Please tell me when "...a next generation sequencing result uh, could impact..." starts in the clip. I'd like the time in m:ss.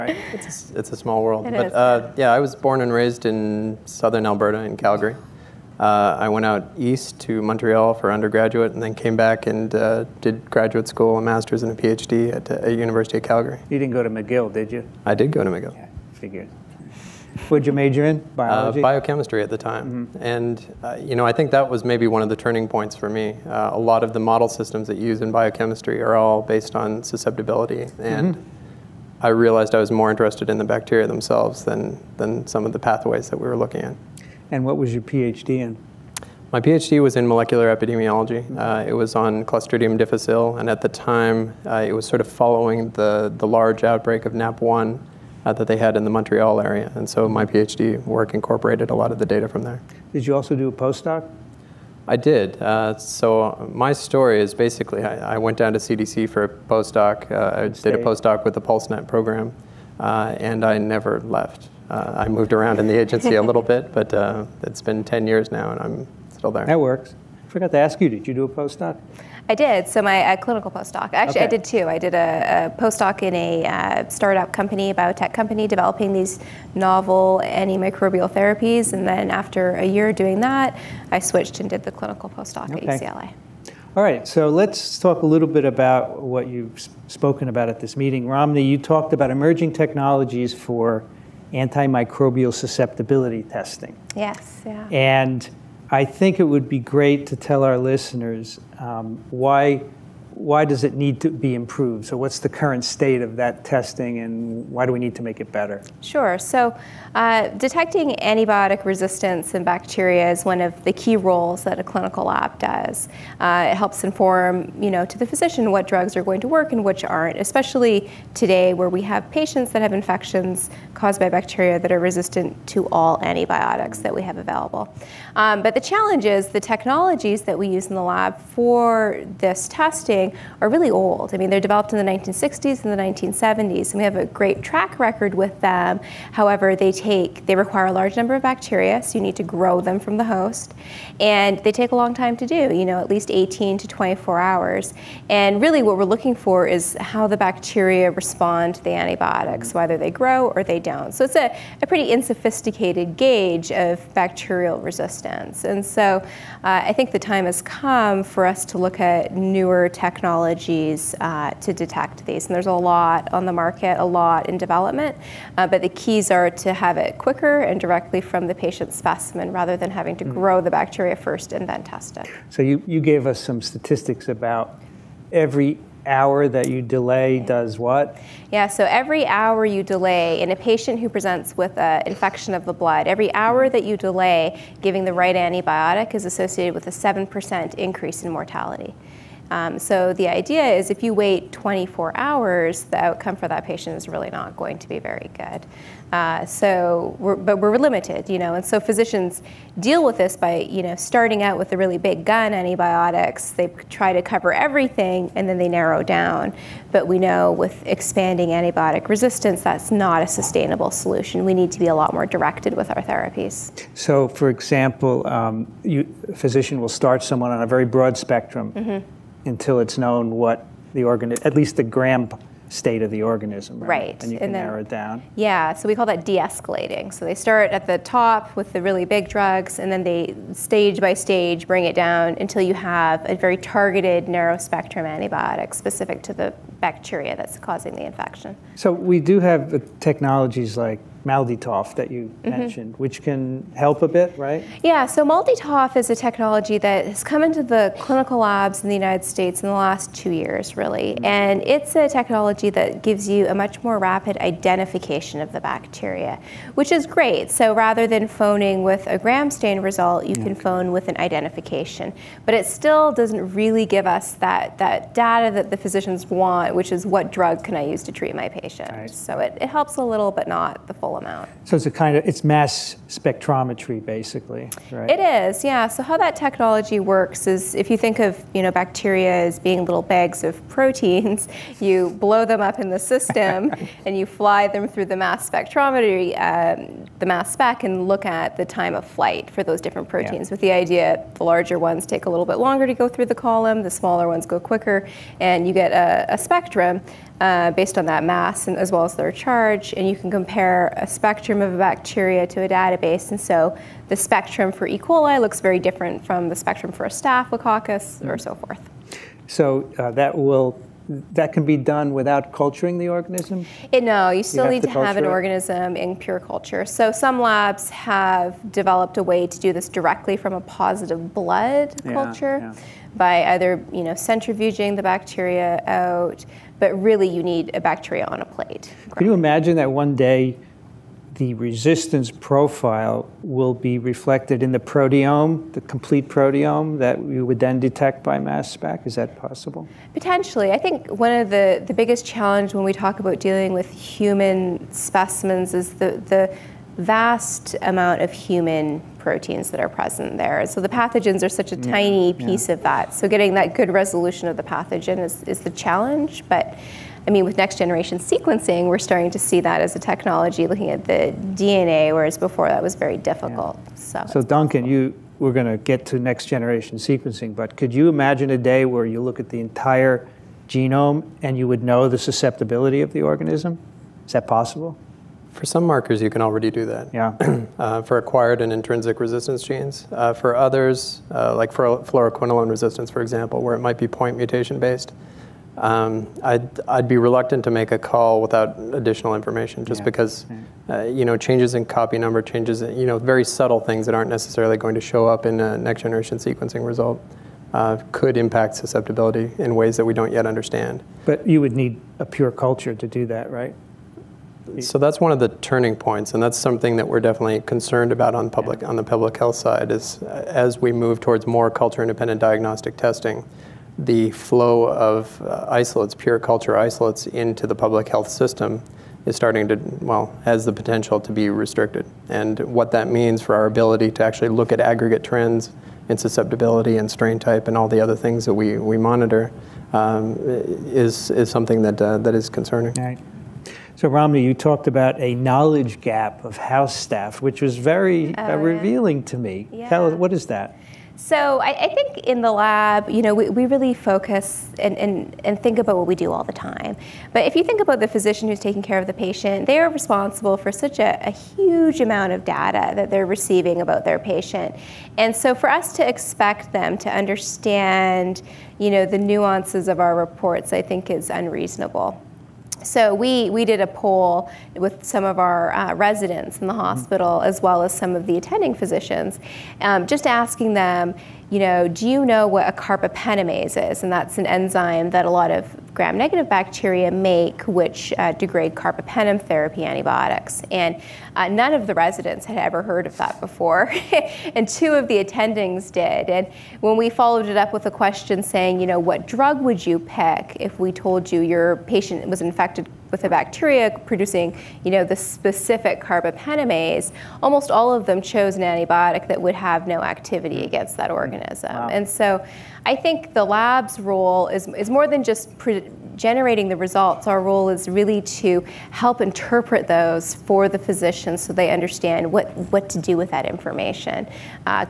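6:35.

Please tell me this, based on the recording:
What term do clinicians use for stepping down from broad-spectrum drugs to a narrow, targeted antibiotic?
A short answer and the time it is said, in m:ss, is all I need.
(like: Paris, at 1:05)
de-escalating, at 3:46.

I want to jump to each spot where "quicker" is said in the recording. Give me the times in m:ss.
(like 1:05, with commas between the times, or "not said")
2:47, 4:54.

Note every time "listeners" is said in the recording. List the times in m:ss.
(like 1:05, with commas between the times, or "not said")
1:37.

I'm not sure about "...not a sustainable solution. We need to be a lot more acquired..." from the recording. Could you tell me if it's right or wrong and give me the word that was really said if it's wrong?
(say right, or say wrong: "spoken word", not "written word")
wrong: "directed", not "acquired".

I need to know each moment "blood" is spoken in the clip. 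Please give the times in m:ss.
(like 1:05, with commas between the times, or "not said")
3:02, 5:21.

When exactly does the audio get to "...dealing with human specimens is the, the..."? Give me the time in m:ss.
5:43.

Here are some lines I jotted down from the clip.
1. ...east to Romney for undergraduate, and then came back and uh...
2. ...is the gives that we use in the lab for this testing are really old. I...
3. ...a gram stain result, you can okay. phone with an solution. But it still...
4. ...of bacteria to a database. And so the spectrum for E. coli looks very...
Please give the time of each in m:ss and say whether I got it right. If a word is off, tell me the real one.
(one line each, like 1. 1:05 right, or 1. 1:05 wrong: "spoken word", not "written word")
1. 0:06 wrong: "Montreal", not "Romney"
2. 2:06 wrong: "technologies", not "gives"
3. 4:19 wrong: "identification", not "solution"
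4. 5:01 right.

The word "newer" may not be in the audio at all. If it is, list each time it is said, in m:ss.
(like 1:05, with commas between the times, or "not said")
2:39.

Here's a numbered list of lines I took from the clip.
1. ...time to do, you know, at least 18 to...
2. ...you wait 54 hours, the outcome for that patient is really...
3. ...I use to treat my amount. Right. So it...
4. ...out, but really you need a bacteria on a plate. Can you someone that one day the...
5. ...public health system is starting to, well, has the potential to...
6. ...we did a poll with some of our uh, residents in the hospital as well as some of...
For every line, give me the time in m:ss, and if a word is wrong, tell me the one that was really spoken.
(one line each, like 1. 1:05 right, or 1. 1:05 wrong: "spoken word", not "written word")
1. 2:22 right
2. 3:11 wrong: "24", not "54"
3. 4:27 wrong: "patient", not "amount"
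4. 5:25 wrong: "imagine", not "someone"
5. 6:57 right
6. 7:43 right.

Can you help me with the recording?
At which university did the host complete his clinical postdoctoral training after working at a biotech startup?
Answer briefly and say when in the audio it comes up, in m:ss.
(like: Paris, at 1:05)
UCLA, at 1:23.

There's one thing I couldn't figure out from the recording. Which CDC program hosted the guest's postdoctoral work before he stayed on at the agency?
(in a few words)
PulseNet.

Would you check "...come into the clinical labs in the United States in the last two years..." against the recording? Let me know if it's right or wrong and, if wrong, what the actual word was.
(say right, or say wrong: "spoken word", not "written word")
right.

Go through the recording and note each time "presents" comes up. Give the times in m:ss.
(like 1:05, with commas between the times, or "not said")
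3:01, 5:49.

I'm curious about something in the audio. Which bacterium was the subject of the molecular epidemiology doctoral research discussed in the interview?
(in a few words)
Clostridium difficile.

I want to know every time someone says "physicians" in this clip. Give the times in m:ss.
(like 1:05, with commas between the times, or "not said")
1:55, 3:18, 3:36, 4:25, 7:28, 7:48, 8:30.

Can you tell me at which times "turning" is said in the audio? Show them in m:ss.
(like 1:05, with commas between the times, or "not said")
0:22, 6:45.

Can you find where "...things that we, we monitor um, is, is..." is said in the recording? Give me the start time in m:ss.
7:08.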